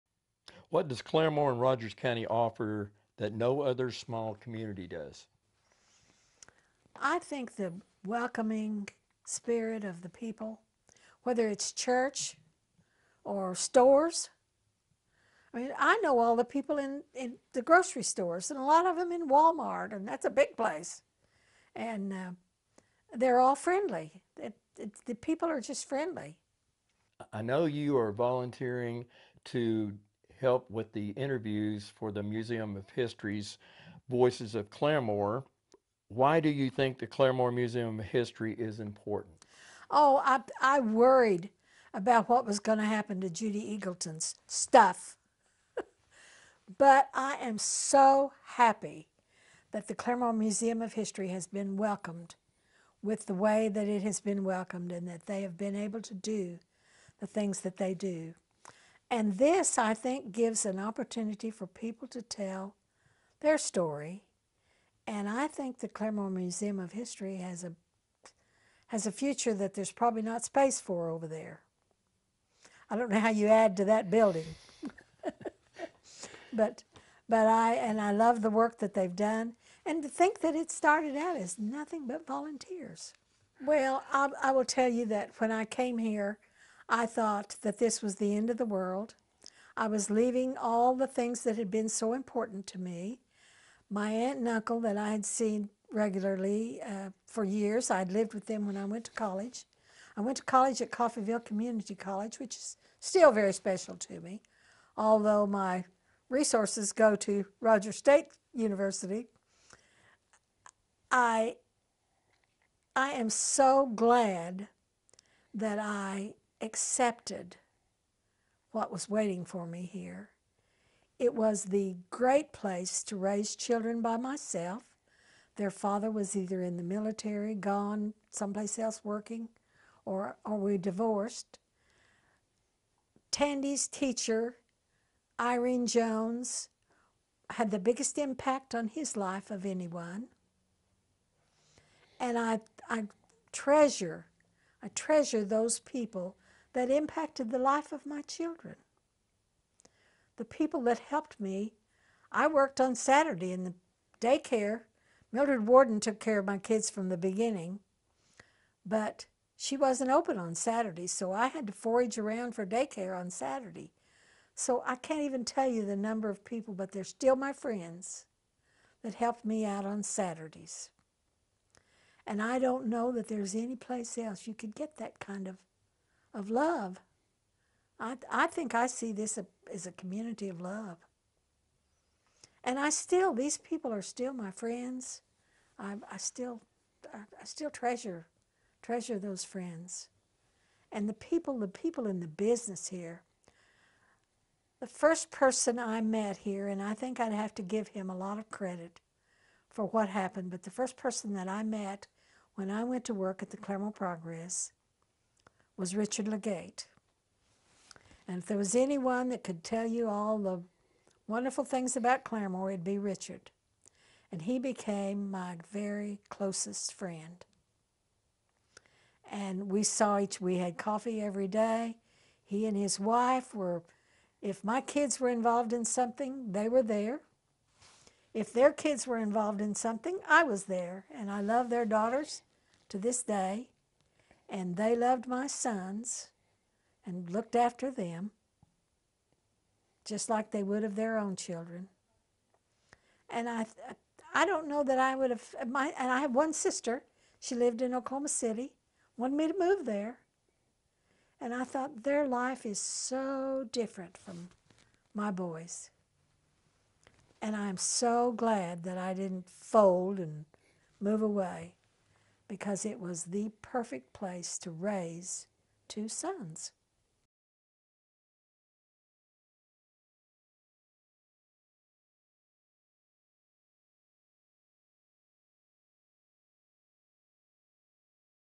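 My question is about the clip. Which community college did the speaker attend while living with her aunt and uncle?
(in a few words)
Coffeyville Community College.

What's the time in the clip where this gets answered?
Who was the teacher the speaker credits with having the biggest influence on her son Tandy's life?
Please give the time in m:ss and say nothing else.
2:15.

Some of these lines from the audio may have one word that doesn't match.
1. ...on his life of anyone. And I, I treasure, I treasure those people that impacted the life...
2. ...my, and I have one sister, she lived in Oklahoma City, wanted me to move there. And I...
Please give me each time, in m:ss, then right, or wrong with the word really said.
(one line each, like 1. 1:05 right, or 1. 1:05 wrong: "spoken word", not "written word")
1. 2:18 right
2. 4:05 right.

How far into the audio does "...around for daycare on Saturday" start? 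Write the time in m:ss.
2:42.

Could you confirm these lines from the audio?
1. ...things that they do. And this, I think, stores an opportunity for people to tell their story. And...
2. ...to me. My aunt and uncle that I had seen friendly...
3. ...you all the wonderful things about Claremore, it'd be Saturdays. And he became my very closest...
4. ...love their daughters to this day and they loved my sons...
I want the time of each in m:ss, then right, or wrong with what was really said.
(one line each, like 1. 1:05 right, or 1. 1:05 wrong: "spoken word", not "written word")
1. 0:57 wrong: "gives", not "stores"
2. 1:32 wrong: "regularly", not "friendly"
3. 3:29 wrong: "Richard", not "Saturdays"
4. 3:51 right.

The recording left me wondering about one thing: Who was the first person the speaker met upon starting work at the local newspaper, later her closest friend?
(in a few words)
Richard Legate.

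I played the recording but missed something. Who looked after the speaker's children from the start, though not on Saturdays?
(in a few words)
Mildred Warden.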